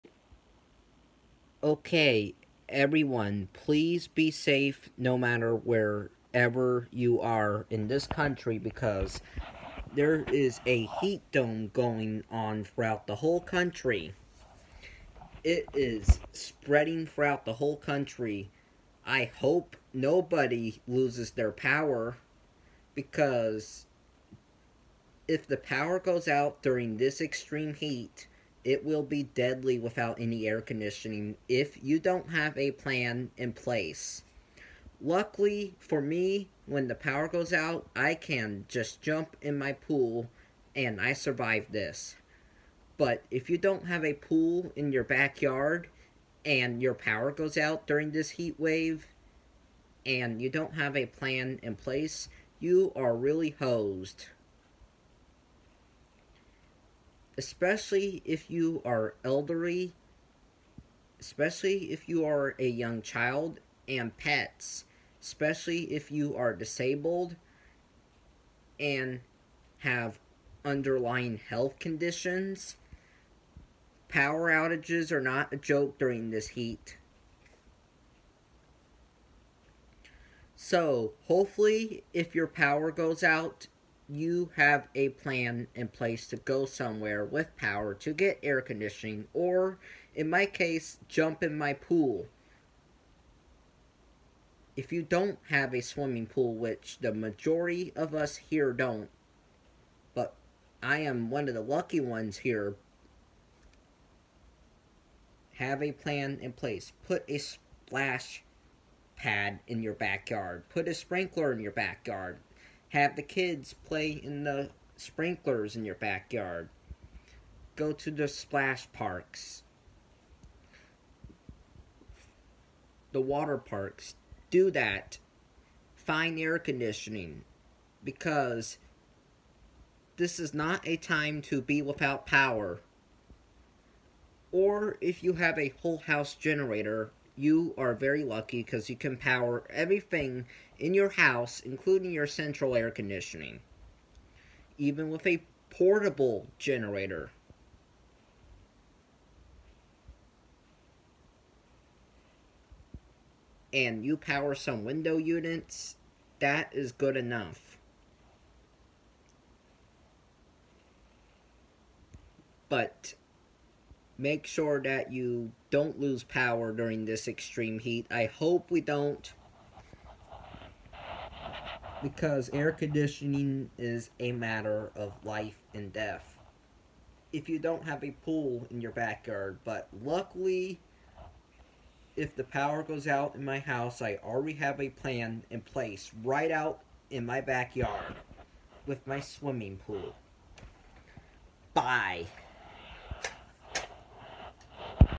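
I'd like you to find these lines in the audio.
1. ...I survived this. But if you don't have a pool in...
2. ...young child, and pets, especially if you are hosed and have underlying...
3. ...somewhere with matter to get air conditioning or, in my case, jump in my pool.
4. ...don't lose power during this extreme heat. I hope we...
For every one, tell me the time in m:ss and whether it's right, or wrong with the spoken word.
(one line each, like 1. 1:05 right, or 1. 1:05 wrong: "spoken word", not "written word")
1. 0:41 right
2. 1:02 wrong: "disabled", not "hosed"
3. 1:26 wrong: "power", not "matter"
4. 2:45 right.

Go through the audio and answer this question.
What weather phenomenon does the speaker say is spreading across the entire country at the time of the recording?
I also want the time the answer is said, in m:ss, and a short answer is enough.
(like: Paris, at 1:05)
heat dome, at 0:10.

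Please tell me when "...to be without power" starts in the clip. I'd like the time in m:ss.
2:11.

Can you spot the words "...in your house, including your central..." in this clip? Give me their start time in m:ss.
2:20.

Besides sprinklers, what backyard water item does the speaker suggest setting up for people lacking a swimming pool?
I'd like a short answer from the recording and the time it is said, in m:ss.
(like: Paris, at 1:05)
splash pad, at 1:47.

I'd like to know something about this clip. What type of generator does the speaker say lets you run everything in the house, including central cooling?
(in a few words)
whole house generator.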